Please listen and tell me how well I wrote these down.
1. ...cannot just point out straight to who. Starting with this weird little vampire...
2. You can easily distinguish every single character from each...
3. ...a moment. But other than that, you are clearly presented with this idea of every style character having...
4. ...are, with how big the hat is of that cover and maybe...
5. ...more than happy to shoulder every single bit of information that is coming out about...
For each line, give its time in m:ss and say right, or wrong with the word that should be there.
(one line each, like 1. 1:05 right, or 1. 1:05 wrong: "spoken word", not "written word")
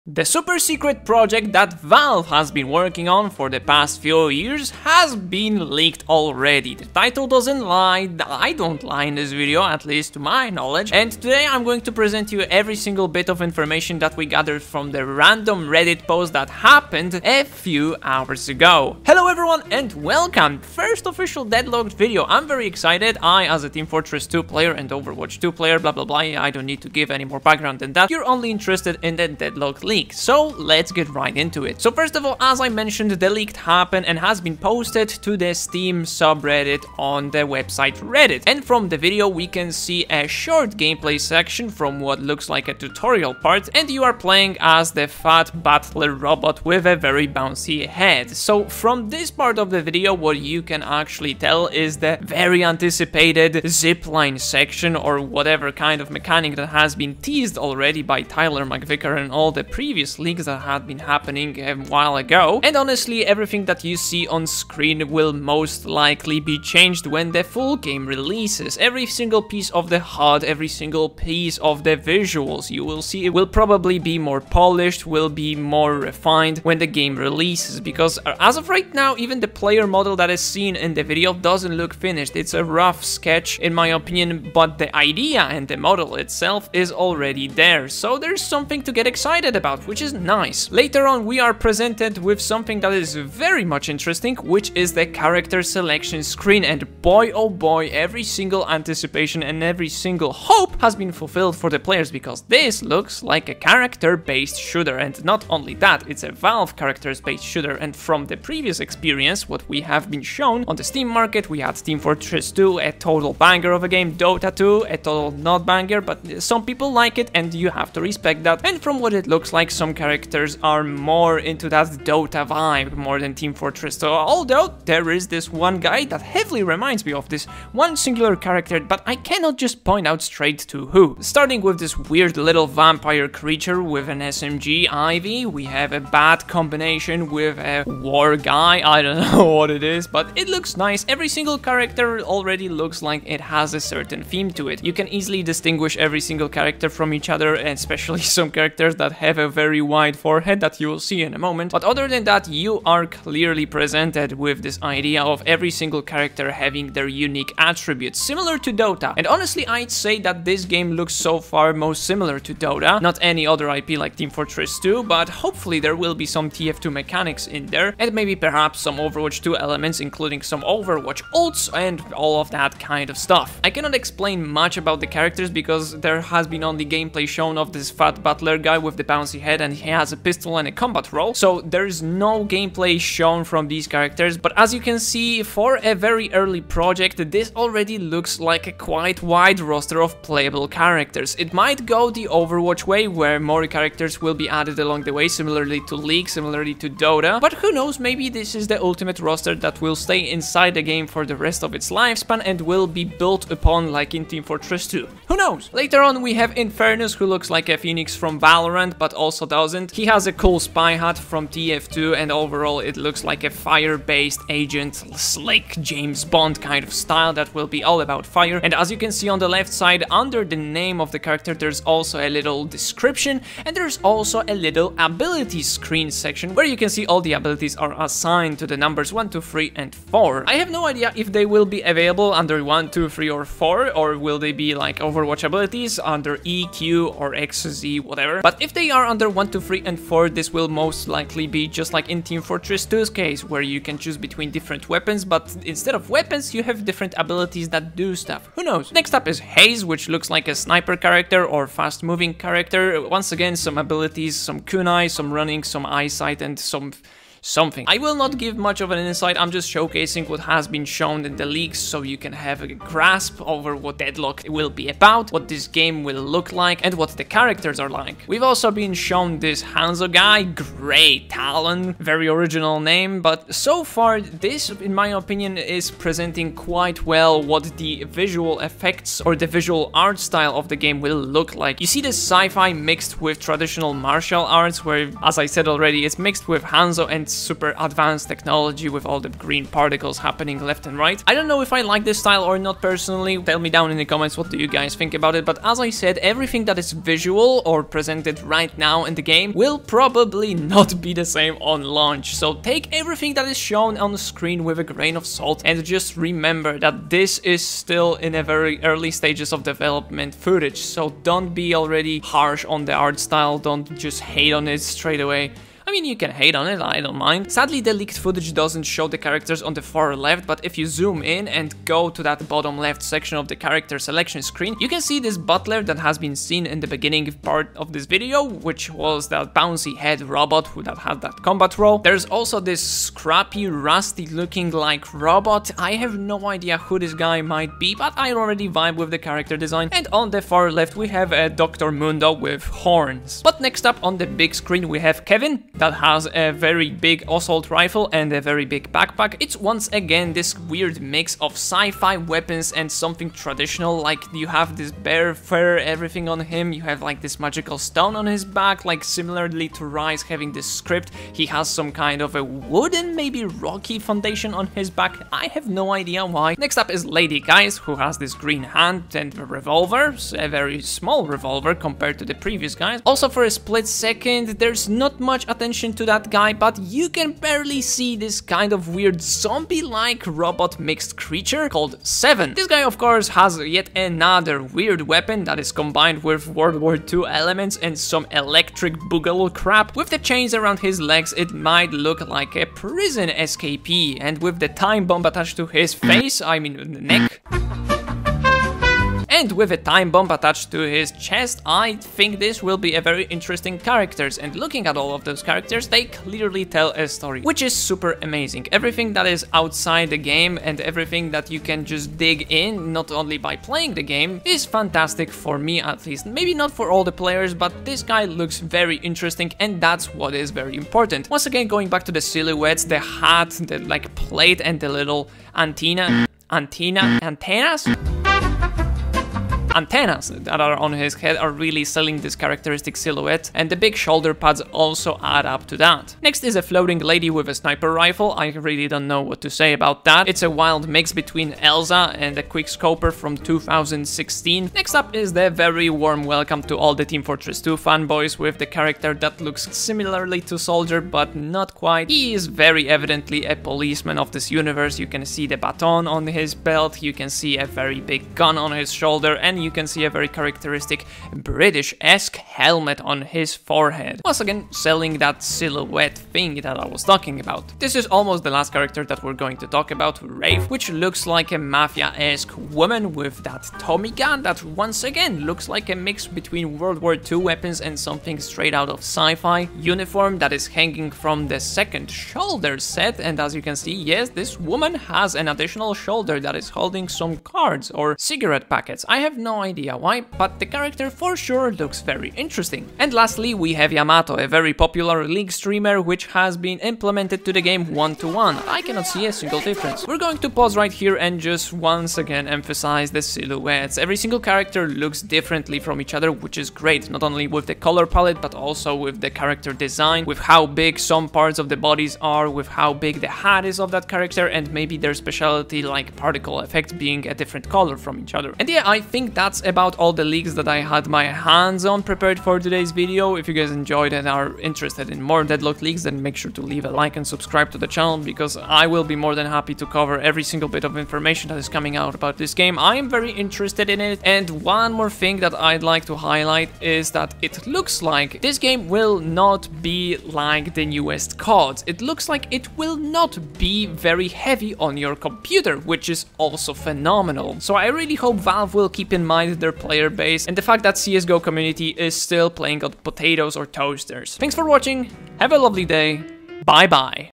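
1. 2:09 right
2. 2:24 right
3. 2:31 wrong: "single", not "style"
4. 8:32 wrong: "character", not "cover"
5. 8:49 wrong: "cover", not "shoulder".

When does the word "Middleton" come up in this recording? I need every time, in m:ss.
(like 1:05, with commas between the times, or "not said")
not said.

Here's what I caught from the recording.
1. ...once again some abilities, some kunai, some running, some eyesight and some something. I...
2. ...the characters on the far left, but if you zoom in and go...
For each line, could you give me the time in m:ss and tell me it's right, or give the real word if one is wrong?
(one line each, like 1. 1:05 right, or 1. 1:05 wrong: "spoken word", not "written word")
1. 4:13 right
2. 5:19 right.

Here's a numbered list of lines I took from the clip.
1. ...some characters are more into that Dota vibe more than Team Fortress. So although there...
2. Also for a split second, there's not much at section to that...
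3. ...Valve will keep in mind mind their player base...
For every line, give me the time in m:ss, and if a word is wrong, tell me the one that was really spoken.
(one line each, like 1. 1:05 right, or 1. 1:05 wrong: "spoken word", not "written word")
1. 1:59 right
2. 6:13 wrong: "attention", not "section"
3. 9:08 right.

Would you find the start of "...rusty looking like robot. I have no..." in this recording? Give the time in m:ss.
5:33.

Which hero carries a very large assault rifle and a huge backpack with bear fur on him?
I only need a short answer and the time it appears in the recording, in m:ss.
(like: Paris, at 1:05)
Kelvin, at 5:45.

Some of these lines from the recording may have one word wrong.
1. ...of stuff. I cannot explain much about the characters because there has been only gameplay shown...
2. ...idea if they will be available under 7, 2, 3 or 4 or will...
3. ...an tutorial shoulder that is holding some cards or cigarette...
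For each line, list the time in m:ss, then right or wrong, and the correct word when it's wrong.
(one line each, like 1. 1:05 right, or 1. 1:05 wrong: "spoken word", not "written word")
1. 2:53 right
2. 3:50 wrong: "1", not "7"
3. 8:05 wrong: "additional", not "tutorial".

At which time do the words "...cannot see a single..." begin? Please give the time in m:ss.
8:18.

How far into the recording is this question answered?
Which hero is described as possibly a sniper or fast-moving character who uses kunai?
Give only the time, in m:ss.
4:09.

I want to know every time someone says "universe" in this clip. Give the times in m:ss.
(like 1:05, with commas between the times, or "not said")
7:34.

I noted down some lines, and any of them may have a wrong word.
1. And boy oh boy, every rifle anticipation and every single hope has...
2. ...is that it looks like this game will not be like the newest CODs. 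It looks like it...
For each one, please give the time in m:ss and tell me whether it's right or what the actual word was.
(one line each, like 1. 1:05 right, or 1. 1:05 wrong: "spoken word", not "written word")
1. 1:36 wrong: "single", not "rifle"
2. 8:56 right.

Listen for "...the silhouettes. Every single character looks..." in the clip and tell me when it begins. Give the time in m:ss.
8:23.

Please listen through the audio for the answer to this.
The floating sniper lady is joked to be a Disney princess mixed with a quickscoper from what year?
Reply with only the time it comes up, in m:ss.
7:23.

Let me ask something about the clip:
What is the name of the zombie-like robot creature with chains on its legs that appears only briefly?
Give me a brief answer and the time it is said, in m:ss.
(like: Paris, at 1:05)
Seven, at 6:22.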